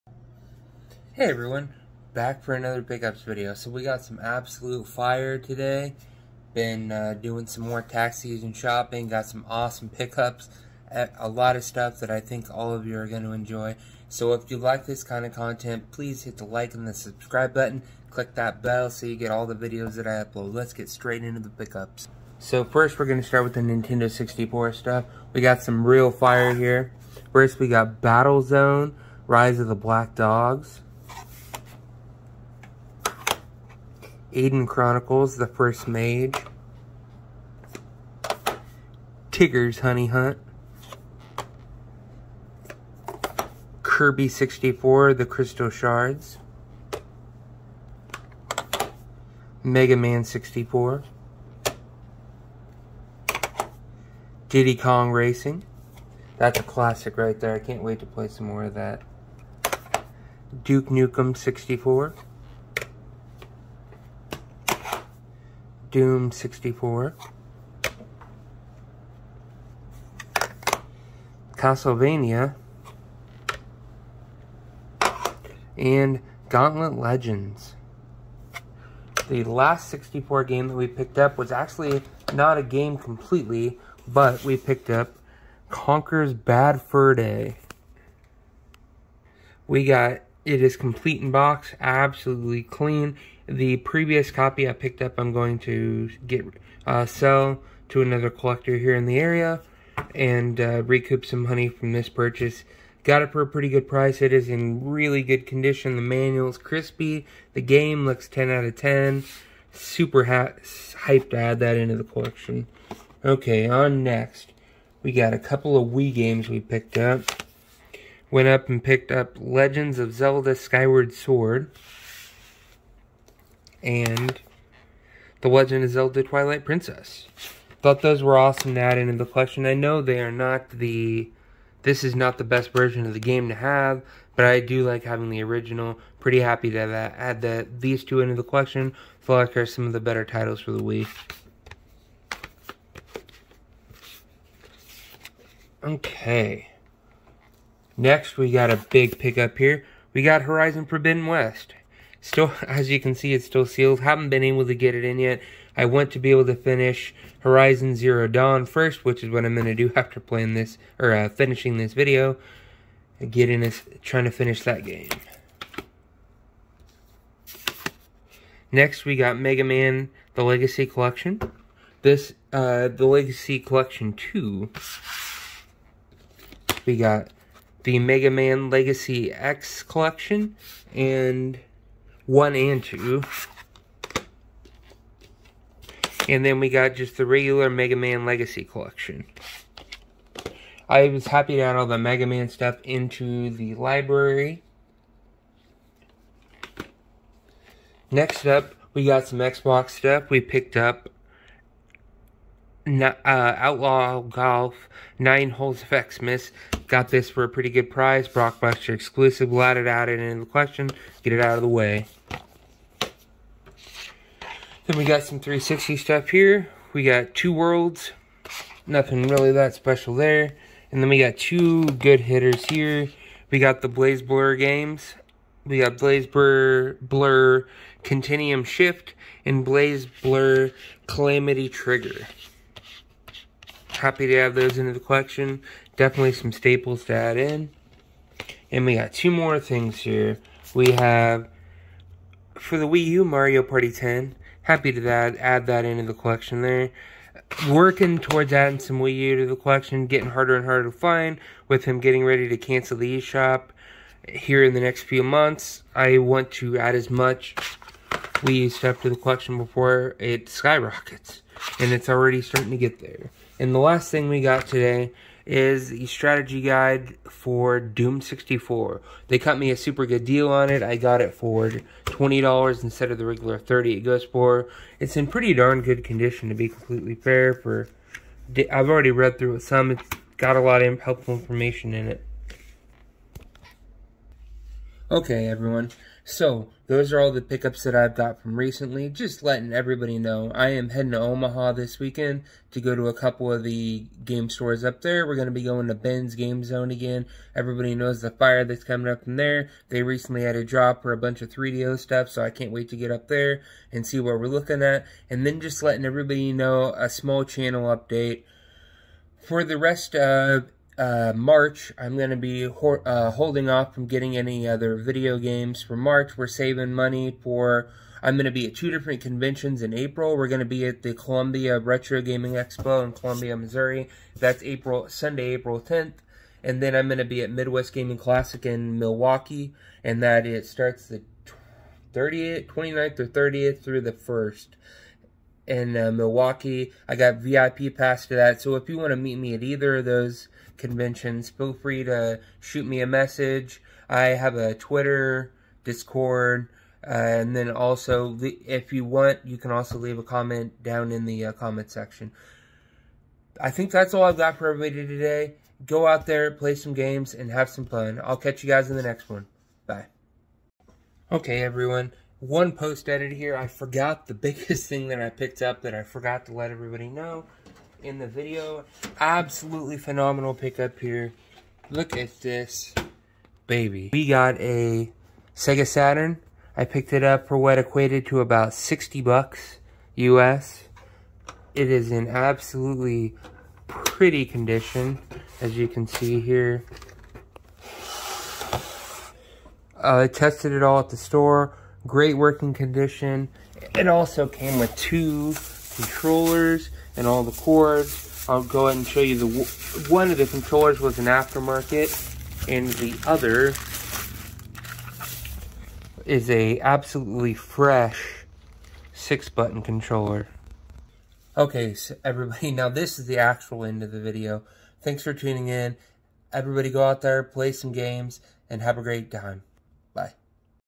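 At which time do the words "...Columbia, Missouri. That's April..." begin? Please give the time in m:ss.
5:23.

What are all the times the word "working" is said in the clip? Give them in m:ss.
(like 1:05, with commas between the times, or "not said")
4:07, 6:32.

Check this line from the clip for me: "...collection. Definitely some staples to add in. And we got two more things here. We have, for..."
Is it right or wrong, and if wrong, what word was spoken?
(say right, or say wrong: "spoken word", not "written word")
right.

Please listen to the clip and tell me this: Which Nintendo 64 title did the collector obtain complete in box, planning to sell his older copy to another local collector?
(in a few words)
Conker's Bad Fur Day.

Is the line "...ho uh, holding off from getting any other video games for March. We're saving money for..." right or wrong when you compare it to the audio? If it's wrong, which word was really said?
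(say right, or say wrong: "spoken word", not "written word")
right.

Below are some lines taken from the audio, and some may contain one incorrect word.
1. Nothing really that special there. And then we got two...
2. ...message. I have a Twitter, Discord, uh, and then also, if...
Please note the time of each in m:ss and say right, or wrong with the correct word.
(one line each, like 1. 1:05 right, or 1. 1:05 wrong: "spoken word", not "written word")
1. 3:38 right
2. 5:43 right.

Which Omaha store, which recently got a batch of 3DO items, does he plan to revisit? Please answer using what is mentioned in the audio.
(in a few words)
Ben's Game Zone.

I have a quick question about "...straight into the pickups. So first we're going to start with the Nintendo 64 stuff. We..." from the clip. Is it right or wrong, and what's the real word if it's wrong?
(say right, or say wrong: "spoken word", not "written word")
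right.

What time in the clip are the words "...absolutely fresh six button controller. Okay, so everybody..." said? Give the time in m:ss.
6:46.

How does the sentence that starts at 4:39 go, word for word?
It's got a lot of helpful information in it.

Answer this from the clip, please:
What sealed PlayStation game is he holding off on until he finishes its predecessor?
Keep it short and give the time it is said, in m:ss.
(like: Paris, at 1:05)
Horizon Forbidden West, at 2:30.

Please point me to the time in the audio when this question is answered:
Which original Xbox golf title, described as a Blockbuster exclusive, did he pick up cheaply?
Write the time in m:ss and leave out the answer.
3:23.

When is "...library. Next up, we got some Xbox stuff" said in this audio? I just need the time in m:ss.
3:13.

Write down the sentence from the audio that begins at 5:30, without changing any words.
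And that it starts the 30th, 29th or 30th through the 1st in uh, Milwaukee.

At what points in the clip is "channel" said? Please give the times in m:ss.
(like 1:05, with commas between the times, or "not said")
5:07.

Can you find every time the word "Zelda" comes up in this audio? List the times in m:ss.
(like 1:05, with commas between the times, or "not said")
2:00, 2:05.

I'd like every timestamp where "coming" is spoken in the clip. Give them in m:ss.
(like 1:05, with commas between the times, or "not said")
4:58.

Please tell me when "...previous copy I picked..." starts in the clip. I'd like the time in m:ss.
1:33.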